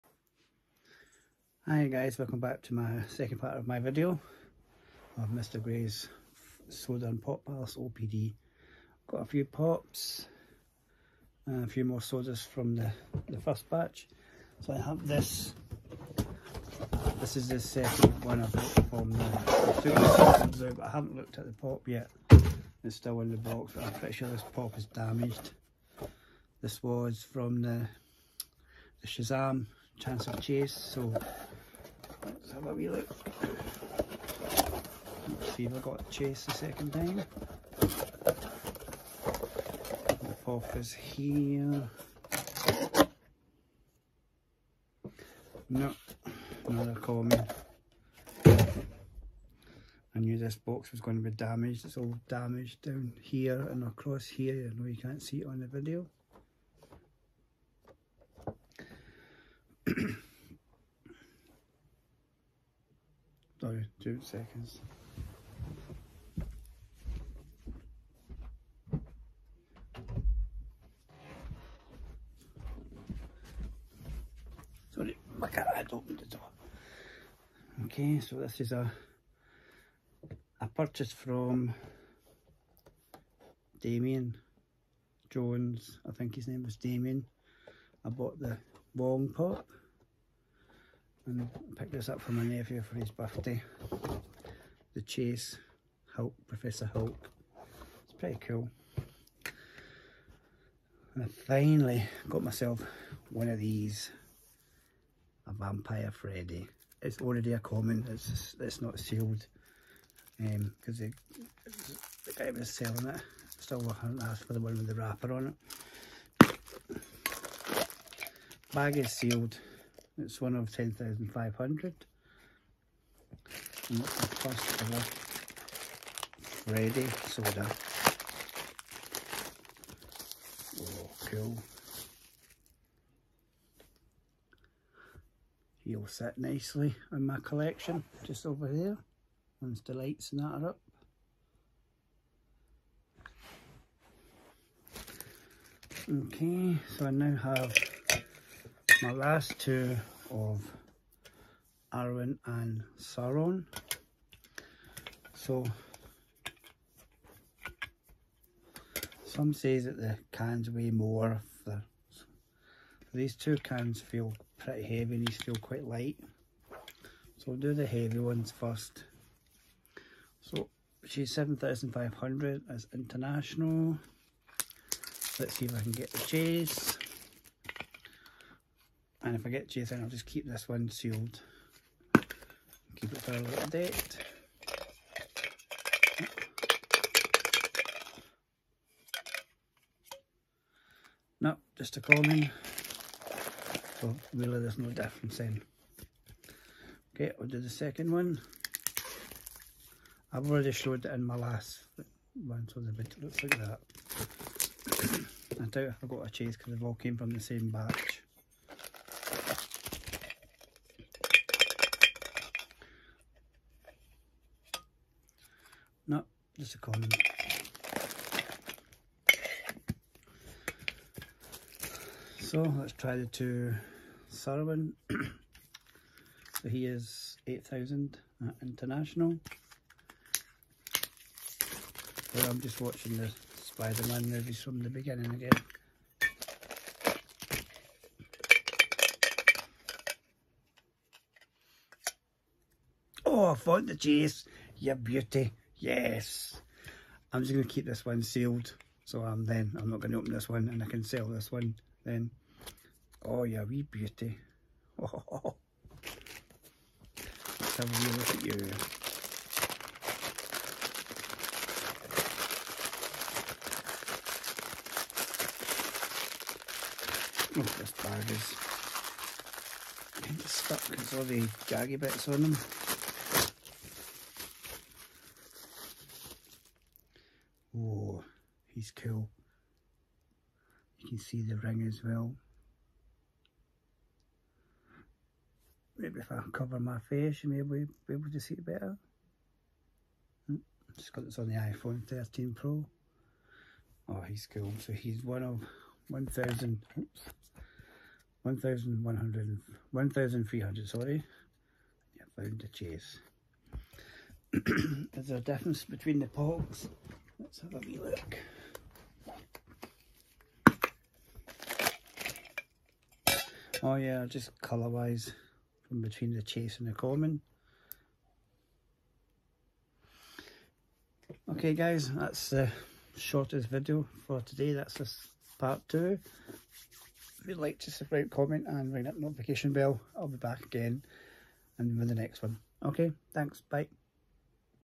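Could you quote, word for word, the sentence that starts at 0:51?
It's all damaged down here and across here.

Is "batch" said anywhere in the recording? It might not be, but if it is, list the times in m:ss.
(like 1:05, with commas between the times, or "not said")
0:13, 3:27.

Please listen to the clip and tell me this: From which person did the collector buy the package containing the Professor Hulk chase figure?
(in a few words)
Damien Jones.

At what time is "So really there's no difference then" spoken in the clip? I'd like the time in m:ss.
3:13.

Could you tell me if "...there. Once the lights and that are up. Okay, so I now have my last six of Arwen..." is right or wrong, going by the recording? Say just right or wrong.
wrong.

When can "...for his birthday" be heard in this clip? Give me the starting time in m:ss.
1:32.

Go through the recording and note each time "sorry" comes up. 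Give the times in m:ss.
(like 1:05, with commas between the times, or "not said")
1:03, 1:14, 5:00.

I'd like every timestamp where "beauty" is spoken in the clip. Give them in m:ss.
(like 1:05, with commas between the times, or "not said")
4:04, 4:13.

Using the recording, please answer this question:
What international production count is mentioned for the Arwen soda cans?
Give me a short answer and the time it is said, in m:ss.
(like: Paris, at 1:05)
7,500, at 2:51.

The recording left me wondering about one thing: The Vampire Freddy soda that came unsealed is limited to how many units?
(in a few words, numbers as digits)
10,500.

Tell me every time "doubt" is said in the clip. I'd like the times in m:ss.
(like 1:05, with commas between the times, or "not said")
3:25.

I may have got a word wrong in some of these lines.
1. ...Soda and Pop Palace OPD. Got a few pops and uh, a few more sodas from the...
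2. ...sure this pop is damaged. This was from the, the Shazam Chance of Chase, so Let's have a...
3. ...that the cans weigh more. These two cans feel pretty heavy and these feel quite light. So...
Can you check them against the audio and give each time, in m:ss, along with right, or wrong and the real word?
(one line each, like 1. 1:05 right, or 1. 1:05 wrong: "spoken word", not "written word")
1. 0:06 right
2. 0:24 right
3. 2:39 right.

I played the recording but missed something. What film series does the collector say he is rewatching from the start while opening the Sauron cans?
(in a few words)
Spider-Man.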